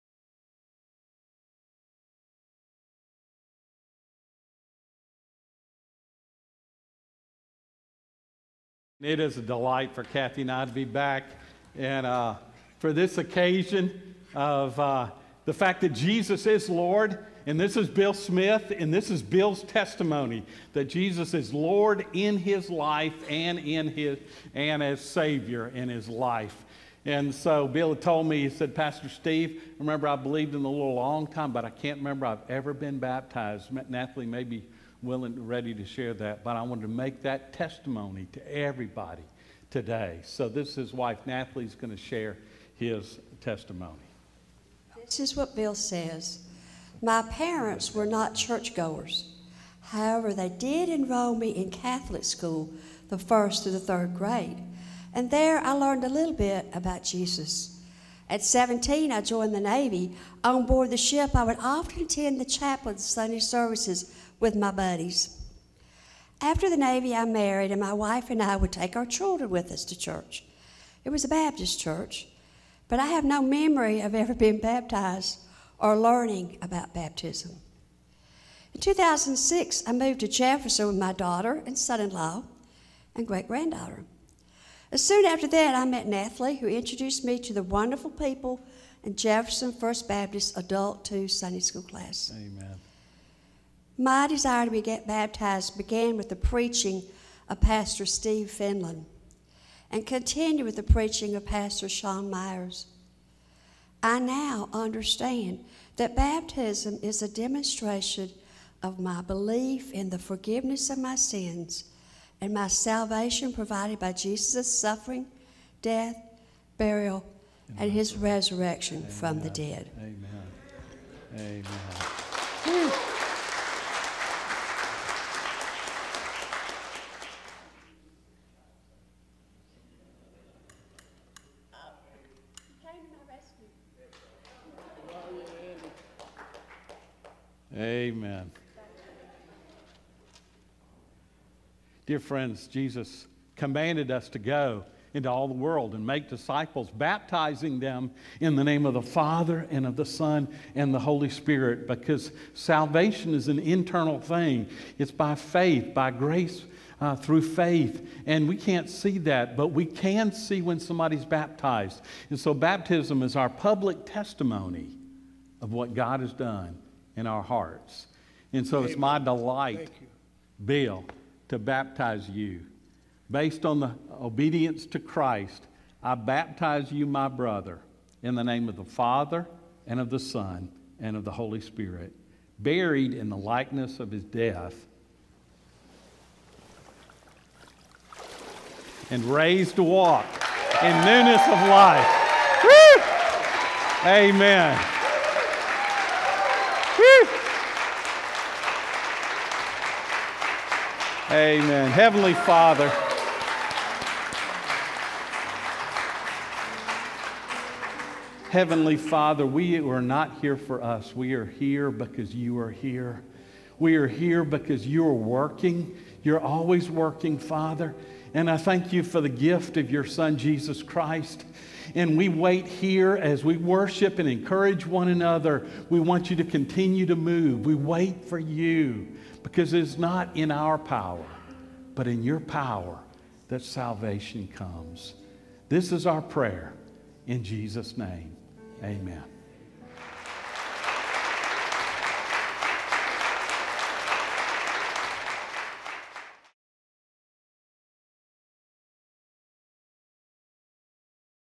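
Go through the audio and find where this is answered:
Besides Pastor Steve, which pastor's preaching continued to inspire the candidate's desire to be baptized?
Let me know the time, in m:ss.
1:41.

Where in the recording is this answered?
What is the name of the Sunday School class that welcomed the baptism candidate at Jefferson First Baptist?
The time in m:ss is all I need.
1:30.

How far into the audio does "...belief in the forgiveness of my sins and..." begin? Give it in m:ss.
1:49.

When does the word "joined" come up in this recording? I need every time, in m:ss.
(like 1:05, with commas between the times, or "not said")
0:59.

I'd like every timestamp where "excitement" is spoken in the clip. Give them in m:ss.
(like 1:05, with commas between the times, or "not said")
not said.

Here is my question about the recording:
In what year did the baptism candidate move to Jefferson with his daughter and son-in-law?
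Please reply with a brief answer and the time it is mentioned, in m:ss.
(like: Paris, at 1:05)
2006, at 1:18.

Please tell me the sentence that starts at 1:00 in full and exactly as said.
On board the ship, I would often attend the chaplain's Sunday services with my buddies.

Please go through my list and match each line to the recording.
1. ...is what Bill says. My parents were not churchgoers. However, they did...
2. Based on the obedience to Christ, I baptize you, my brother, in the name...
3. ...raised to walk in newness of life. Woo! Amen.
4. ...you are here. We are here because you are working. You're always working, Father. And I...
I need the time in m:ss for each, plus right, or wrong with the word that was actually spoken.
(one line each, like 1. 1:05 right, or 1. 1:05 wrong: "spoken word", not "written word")
1. 0:45 right
2. 2:53 right
3. 3:09 right
4. 3:32 right.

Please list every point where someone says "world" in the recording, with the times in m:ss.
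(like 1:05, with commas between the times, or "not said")
2:25.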